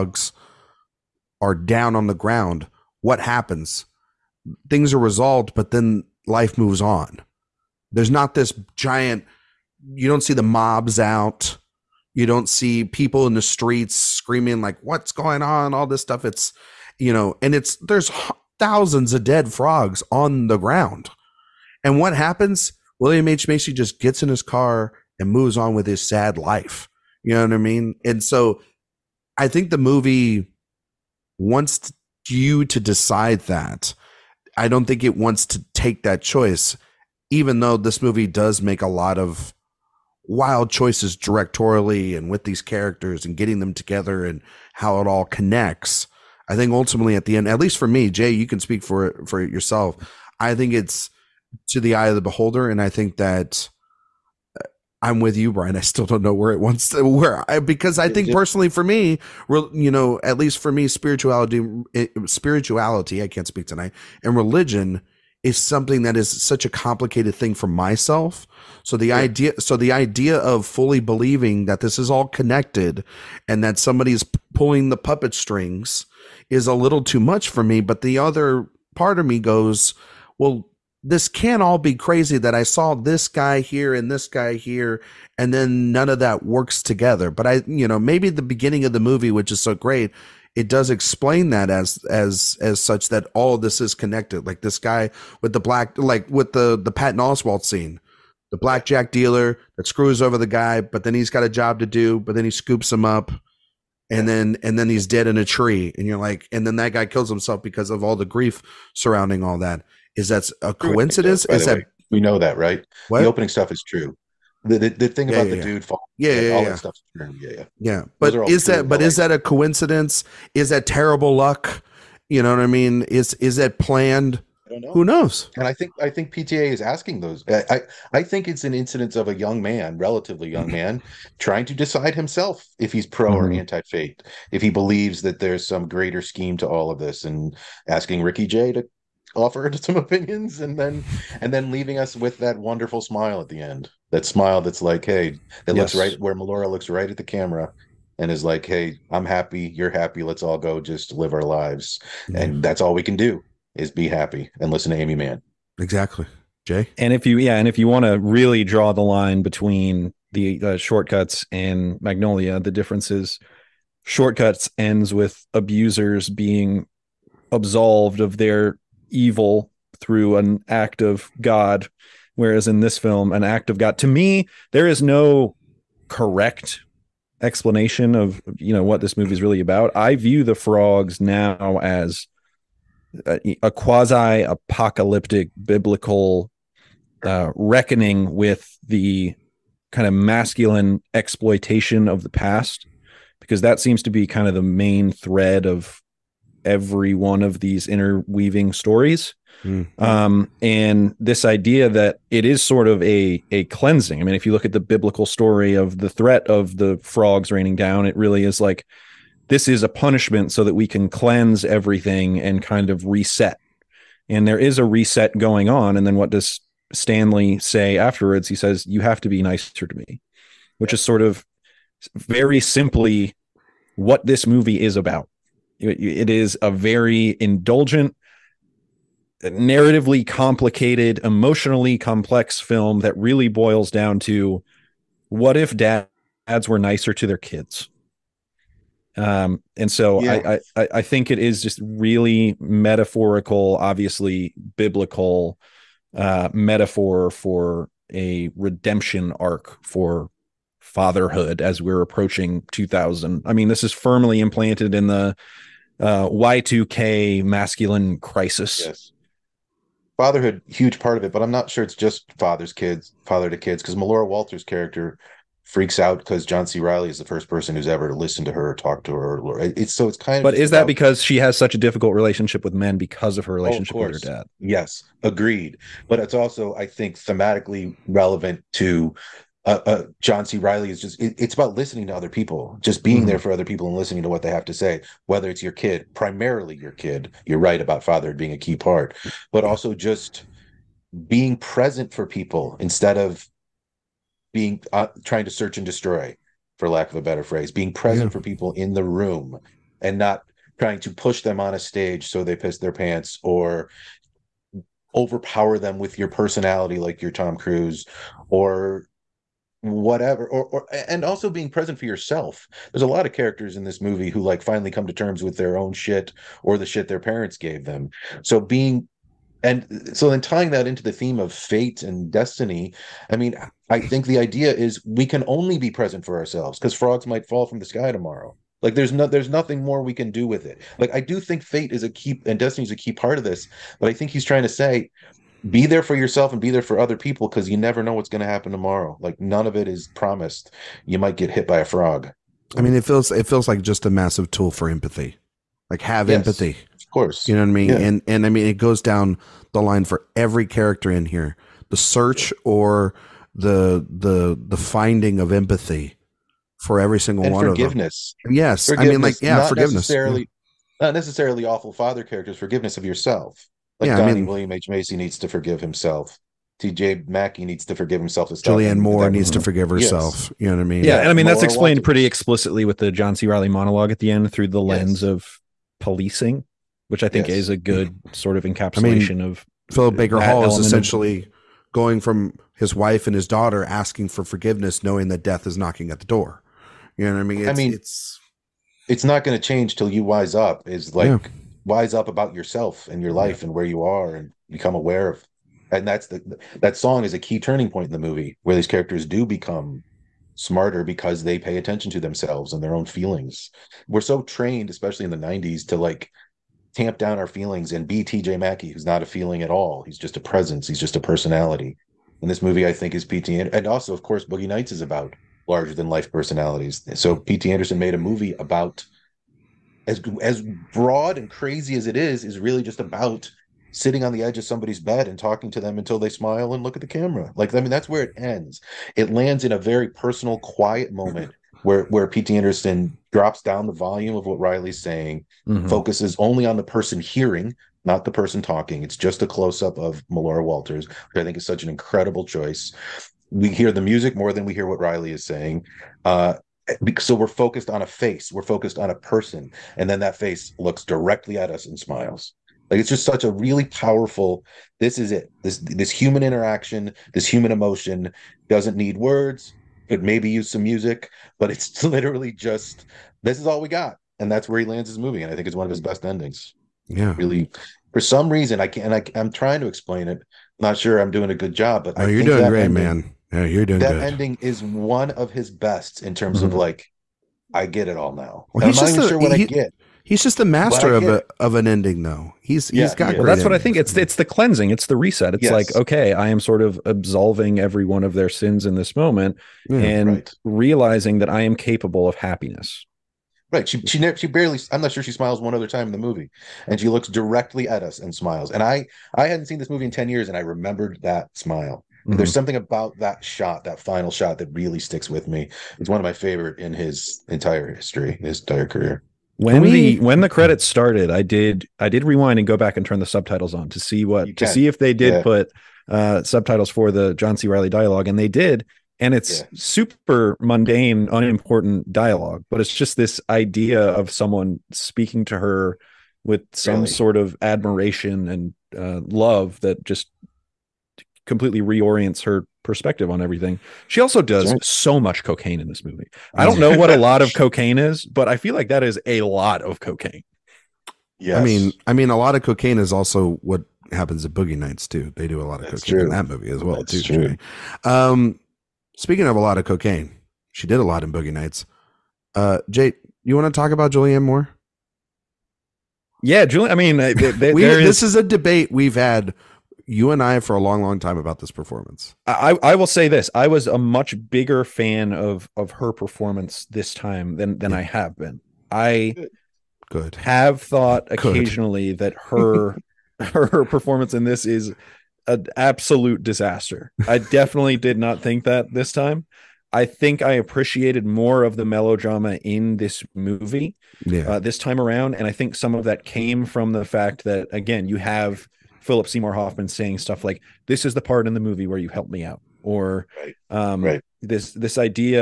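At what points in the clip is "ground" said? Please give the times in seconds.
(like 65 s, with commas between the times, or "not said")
2 s, 20 s.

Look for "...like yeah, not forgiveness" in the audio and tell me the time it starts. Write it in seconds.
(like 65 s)
359 s.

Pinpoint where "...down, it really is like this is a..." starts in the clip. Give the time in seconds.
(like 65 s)
207 s.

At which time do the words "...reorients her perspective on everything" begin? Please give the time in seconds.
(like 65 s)
531 s.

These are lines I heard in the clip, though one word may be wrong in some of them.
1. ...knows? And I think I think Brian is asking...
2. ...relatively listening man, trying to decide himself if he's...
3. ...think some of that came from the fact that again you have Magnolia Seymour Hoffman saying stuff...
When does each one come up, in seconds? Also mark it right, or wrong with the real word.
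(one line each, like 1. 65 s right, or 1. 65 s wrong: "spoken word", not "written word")
1. 125 s wrong: "PTA", not "Brian"
2. 129 s wrong: "young", not "listening"
3. 585 s wrong: "Philip", not "Magnolia".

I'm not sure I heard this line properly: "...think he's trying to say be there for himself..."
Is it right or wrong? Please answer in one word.
wrong.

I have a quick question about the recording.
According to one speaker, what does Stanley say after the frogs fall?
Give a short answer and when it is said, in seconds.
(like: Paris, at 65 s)
You have to be nicer to me, at 218 s.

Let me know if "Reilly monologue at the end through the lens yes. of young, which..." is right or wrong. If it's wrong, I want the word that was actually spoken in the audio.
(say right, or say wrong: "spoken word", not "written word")
wrong: "policing", not "young".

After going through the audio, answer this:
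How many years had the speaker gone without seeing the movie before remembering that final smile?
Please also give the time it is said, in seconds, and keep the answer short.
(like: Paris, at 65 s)
10, at 500 s.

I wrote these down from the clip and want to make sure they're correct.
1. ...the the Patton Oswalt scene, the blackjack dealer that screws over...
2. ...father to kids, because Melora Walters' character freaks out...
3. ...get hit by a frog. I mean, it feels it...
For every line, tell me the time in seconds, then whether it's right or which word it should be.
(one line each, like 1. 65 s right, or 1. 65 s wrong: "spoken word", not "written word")
1. 96 s right
2. 263 s right
3. 341 s right.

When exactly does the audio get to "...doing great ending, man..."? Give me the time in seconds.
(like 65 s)
472 s.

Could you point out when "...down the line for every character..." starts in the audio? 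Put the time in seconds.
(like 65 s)
349 s.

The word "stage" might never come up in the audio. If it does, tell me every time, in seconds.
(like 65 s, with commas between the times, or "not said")
301 s.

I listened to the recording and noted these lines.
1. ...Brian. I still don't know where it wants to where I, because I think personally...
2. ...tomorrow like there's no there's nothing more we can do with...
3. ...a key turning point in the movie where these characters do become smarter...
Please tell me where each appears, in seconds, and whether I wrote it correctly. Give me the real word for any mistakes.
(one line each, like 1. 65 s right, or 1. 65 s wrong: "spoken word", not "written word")
1. 55 s right
2. 328 s right
3. 397 s right.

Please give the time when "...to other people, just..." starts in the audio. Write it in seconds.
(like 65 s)
282 s.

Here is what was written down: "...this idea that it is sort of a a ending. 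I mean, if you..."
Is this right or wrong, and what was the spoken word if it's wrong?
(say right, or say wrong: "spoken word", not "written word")
wrong: "cleansing", not "ending".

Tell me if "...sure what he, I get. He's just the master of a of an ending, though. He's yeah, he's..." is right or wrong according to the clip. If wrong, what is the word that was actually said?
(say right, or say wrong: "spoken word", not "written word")
right.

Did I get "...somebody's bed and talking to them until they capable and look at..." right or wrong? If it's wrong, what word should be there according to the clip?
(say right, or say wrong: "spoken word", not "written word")
wrong: "smile", not "capable".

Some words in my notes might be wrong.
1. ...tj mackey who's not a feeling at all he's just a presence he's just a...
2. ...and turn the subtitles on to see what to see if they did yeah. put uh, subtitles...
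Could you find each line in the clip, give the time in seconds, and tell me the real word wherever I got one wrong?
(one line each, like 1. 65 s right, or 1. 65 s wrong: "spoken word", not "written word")
1. 408 s right
2. 512 s right.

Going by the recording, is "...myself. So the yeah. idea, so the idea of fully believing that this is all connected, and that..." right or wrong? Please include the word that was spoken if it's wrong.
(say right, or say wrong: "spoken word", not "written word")
right.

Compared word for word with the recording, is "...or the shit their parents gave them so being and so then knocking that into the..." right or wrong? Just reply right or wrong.
wrong.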